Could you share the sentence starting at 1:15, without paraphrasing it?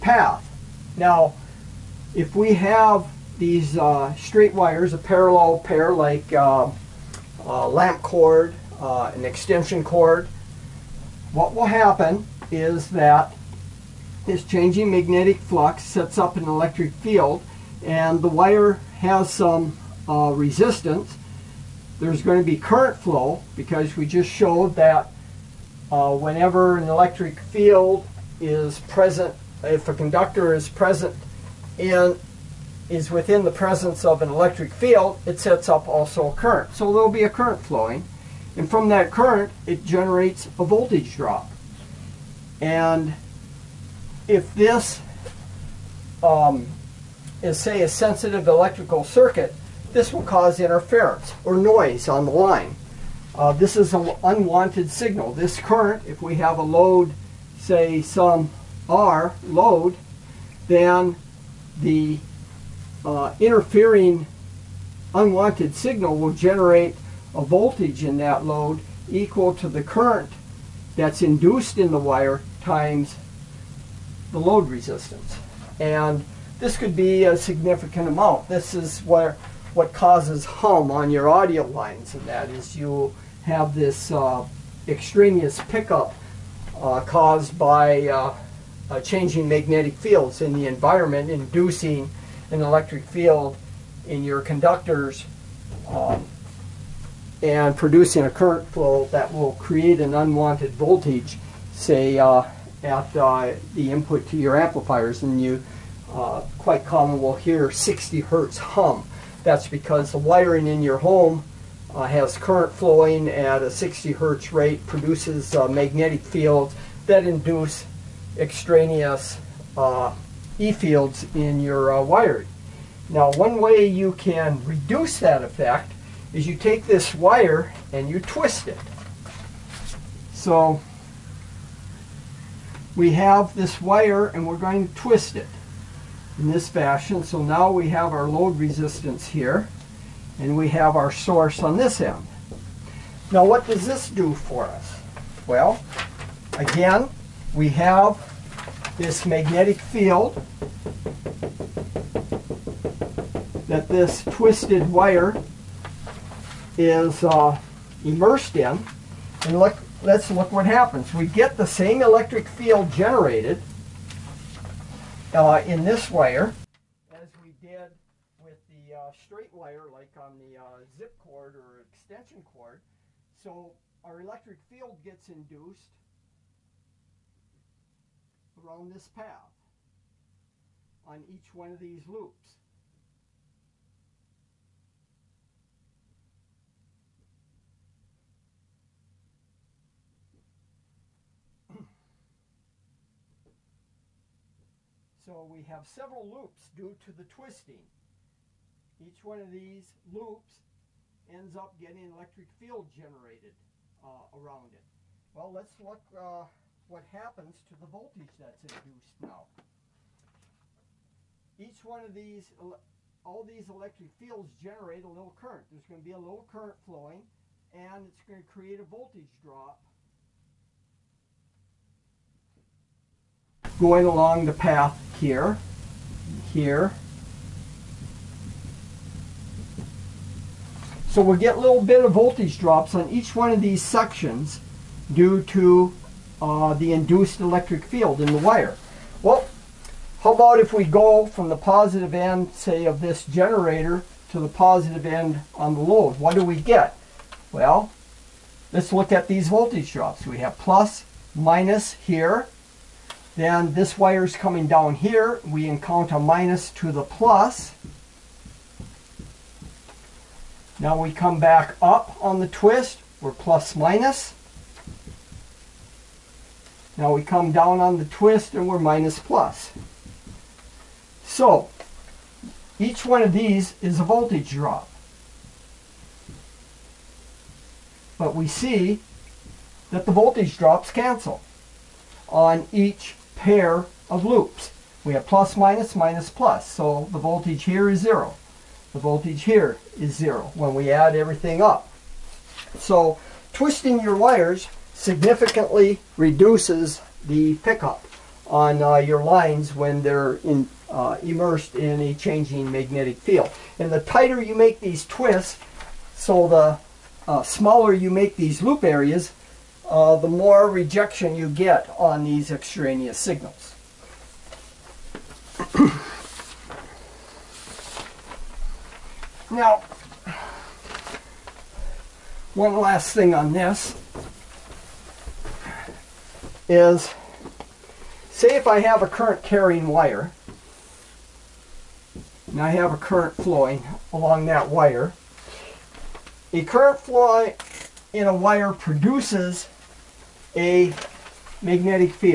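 And this could be a significant amount.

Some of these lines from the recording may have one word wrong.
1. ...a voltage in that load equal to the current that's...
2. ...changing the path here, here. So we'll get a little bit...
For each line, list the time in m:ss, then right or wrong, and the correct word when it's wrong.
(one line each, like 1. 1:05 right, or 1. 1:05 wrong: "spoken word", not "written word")
1. 1:07 right
2. 3:44 wrong: "along", not "changing".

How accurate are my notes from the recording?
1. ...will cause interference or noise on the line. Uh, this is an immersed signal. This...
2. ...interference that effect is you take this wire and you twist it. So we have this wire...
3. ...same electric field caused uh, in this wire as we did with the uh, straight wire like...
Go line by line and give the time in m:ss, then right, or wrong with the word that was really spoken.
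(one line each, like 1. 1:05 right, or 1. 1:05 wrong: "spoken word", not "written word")
1. 0:50 wrong: "unwanted", not "immersed"
2. 2:04 wrong: "reduce", not "interference"
3. 2:41 wrong: "generated", not "caused".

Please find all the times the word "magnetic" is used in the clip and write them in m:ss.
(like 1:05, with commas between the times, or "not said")
0:14, 1:29, 1:55, 2:29, 5:02, 5:41.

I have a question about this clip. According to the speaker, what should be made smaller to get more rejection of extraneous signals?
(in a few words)
Loop areas.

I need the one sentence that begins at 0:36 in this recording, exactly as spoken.
So there'll be a current flowing.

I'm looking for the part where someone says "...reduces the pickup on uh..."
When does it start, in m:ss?
4:56.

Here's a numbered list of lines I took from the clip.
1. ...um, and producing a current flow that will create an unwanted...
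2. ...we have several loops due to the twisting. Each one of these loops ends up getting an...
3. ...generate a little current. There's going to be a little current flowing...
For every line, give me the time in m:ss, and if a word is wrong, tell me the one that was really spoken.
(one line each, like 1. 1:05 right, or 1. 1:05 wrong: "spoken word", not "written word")
1. 1:35 right
2. 3:15 right
3. 3:34 right.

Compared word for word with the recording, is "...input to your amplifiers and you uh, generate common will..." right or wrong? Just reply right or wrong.
wrong.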